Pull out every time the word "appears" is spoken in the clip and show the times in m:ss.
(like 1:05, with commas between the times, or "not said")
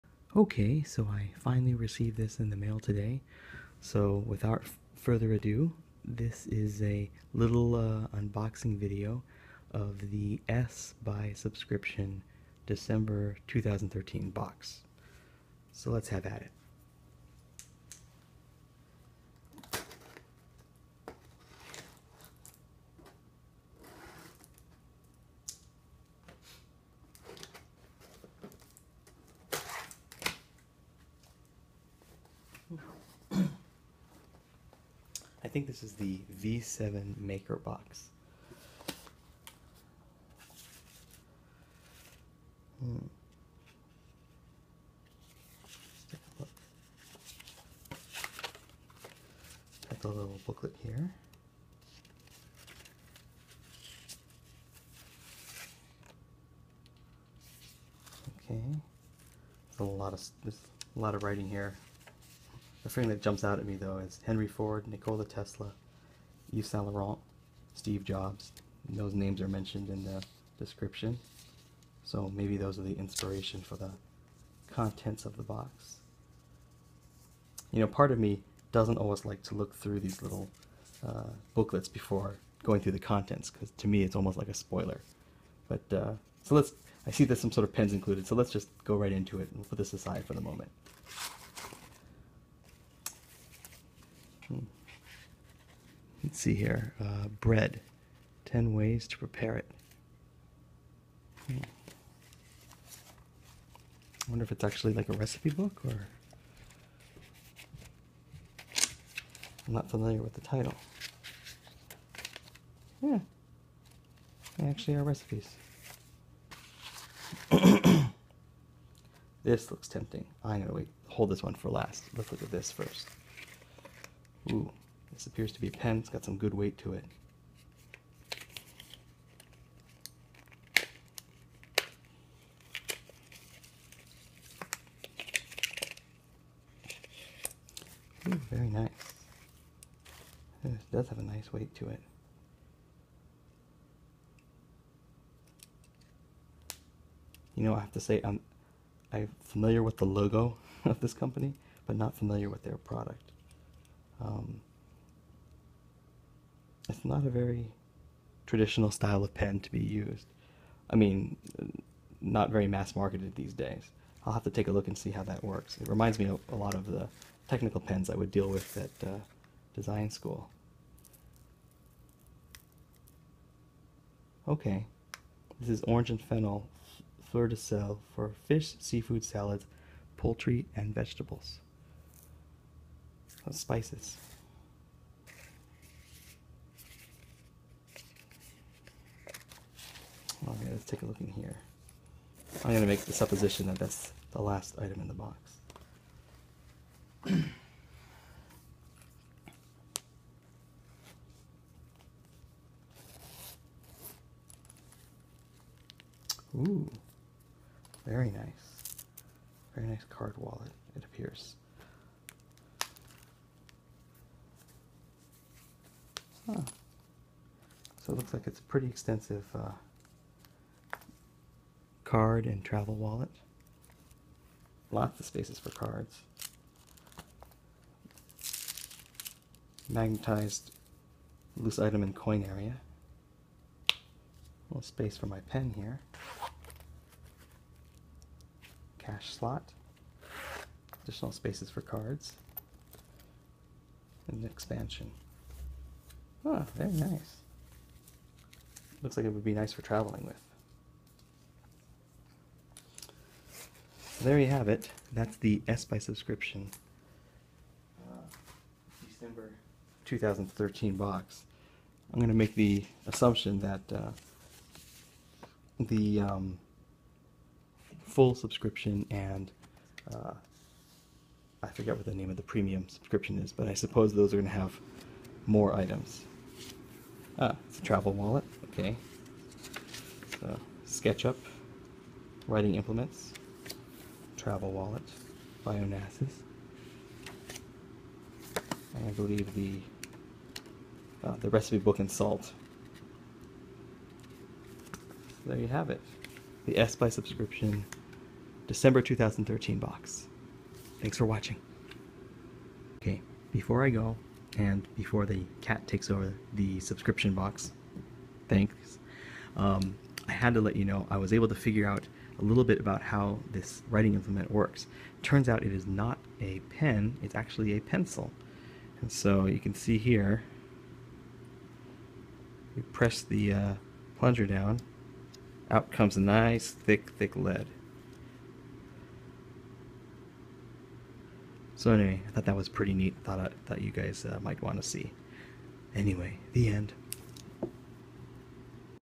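2:05, 3:31.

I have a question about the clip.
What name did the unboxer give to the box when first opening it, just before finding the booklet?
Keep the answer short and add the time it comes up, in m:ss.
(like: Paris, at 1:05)
V7 Maker Box, at 0:36.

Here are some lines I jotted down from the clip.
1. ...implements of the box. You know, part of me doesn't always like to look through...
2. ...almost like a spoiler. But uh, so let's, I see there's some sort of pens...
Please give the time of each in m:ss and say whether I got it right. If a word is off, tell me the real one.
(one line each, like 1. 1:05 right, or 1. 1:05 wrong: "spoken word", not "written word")
1. 1:14 wrong: "contents", not "implements"
2. 1:24 right.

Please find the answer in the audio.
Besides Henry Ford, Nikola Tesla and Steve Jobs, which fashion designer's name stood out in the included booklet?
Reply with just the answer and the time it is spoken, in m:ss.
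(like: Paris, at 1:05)
Yves Saint Laurent, at 1:06.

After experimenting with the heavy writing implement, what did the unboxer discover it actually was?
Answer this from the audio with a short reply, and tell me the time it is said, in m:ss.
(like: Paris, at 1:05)
A pencil, at 5:17.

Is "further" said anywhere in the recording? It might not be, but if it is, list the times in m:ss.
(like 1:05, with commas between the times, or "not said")
0:04.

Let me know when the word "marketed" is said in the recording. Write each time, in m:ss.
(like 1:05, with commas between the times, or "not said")
2:42.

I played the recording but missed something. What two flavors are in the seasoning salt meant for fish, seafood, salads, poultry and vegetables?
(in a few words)
Orange and fennel.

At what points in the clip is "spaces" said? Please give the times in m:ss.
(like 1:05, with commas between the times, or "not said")
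3:45, 3:54, 4:01.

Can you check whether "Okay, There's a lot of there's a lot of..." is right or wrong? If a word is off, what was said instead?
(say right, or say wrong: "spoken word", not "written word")
right.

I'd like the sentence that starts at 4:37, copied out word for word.
Ah, it's a travel wallet, okay.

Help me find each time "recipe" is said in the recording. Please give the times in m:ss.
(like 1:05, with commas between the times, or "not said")
1:45, 1:55, 4:51.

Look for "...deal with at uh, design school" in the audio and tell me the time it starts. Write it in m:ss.
2:48.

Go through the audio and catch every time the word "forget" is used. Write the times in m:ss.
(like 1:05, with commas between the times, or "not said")
4:31.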